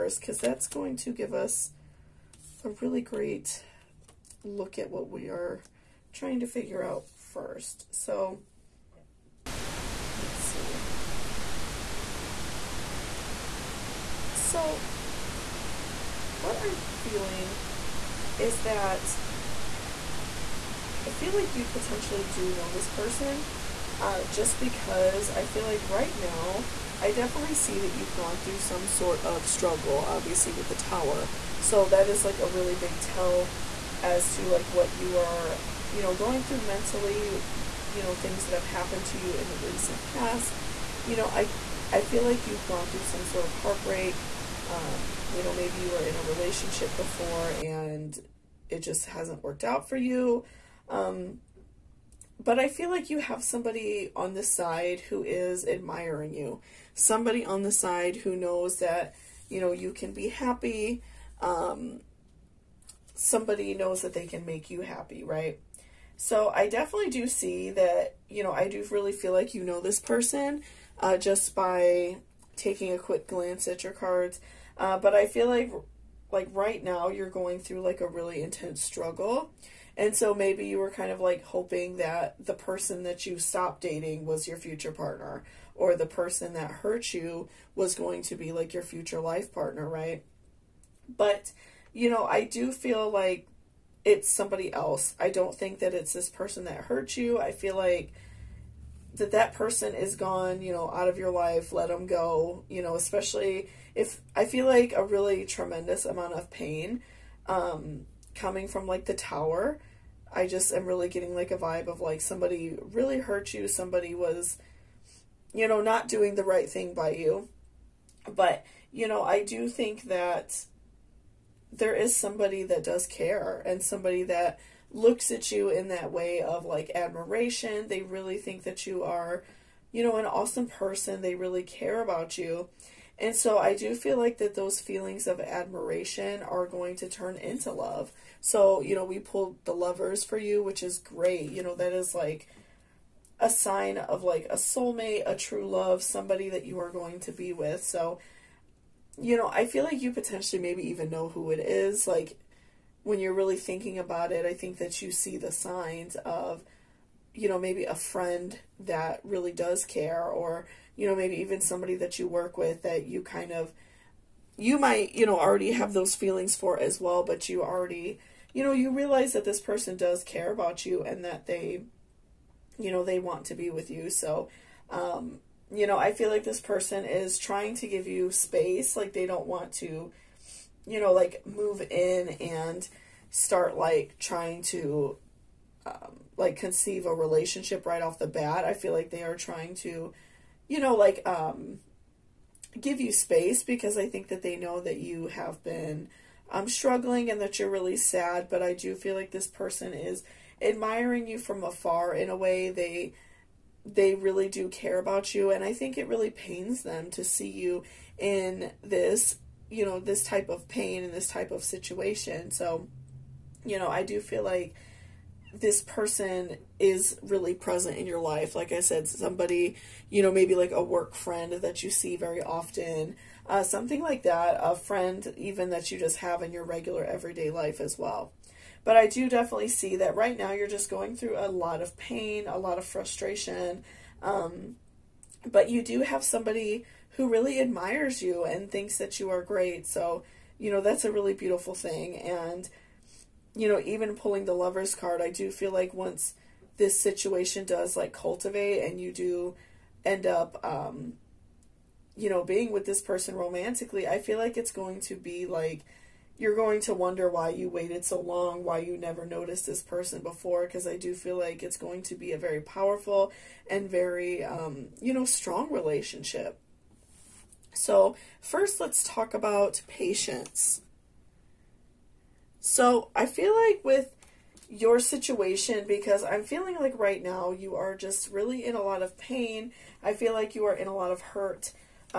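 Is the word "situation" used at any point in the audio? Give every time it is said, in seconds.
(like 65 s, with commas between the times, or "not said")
211 s, 246 s, 274 s.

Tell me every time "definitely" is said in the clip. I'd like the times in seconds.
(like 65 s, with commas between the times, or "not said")
27 s, 66 s, 229 s.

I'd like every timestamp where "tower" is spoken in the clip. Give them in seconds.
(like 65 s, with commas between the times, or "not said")
30 s, 109 s.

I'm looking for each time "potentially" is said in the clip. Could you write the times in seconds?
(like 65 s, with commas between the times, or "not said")
21 s, 150 s.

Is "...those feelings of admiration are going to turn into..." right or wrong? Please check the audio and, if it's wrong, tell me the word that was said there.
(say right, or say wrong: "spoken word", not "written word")
right.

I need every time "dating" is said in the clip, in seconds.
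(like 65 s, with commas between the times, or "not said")
83 s.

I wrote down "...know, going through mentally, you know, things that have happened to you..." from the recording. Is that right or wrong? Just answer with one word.
right.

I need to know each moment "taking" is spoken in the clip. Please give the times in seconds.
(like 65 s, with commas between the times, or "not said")
72 s.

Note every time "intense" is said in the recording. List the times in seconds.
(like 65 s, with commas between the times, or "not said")
78 s.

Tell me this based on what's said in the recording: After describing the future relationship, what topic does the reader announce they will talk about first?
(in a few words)
Patience.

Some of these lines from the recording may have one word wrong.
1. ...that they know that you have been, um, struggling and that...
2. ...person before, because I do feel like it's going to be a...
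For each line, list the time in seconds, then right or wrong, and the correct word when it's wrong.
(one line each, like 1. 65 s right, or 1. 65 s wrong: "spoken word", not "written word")
1. 194 s right
2. 259 s right.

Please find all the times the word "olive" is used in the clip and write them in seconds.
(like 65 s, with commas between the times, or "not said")
not said.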